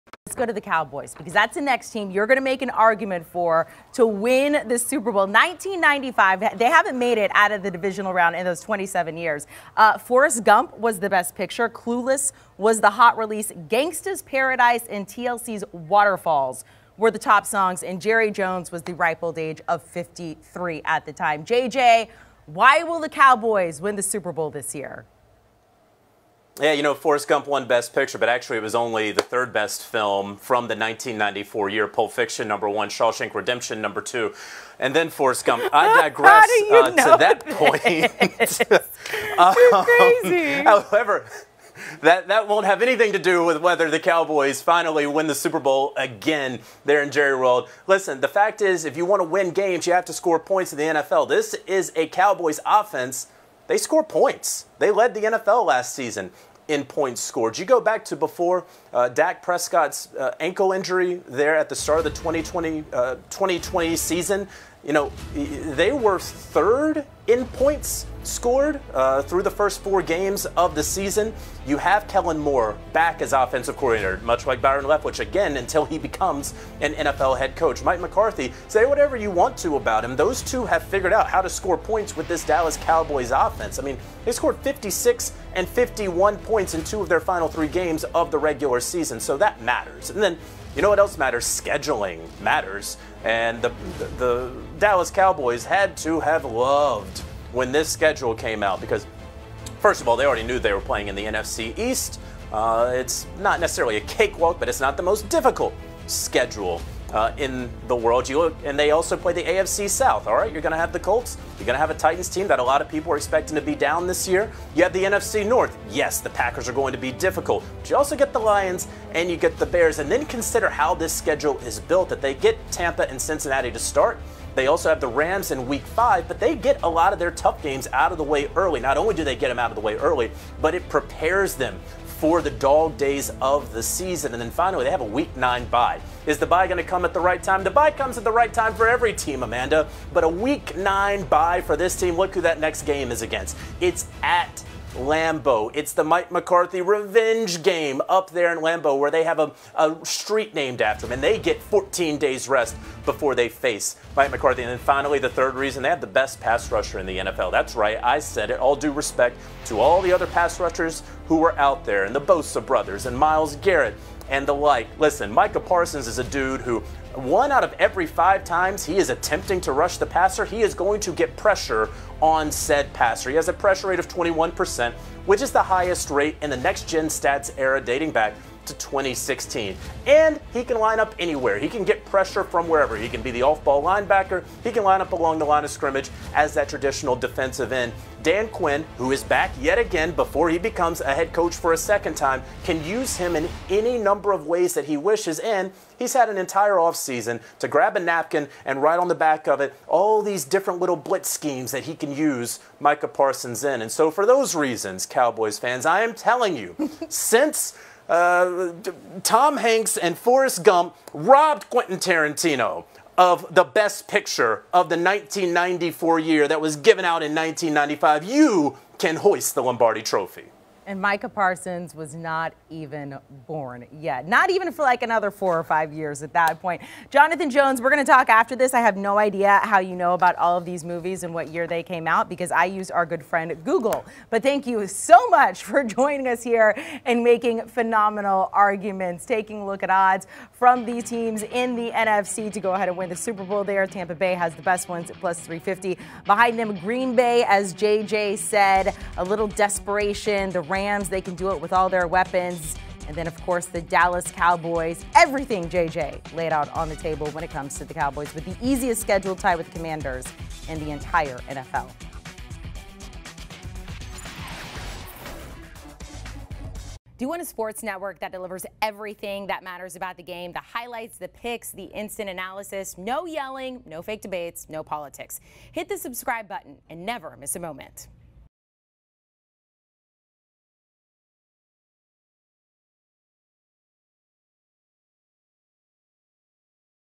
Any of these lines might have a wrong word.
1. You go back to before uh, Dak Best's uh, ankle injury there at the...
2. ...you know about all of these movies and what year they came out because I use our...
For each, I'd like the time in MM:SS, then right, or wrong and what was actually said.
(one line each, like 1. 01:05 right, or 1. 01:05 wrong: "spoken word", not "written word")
1. 00:57 wrong: "Prescott", not "Best"
2. 03:49 right.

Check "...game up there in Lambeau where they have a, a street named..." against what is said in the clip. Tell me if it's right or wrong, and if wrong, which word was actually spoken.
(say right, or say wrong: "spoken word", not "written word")
right.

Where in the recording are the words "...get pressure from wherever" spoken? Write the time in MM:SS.
03:01.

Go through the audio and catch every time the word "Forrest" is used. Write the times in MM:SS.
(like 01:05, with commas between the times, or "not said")
00:09, 00:26, 00:35, 03:30.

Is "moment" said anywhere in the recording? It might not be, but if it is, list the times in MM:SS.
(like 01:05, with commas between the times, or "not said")
04:37.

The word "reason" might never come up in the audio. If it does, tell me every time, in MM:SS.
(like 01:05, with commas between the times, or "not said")
02:35, 03:24.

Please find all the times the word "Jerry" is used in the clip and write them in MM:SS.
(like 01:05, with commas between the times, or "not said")
00:18, 00:47.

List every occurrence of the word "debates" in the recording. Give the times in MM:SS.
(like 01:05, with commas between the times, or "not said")
04:34.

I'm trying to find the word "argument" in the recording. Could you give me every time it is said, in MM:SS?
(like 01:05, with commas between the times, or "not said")
00:02, 03:58.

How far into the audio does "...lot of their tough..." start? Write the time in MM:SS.
02:06.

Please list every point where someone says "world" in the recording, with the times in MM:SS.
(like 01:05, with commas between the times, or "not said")
00:47, 01:47.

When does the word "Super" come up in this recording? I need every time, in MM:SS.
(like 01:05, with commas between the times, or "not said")
00:04, 00:24, 00:45, 04:03.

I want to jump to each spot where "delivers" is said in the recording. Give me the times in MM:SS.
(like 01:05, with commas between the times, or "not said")
04:28.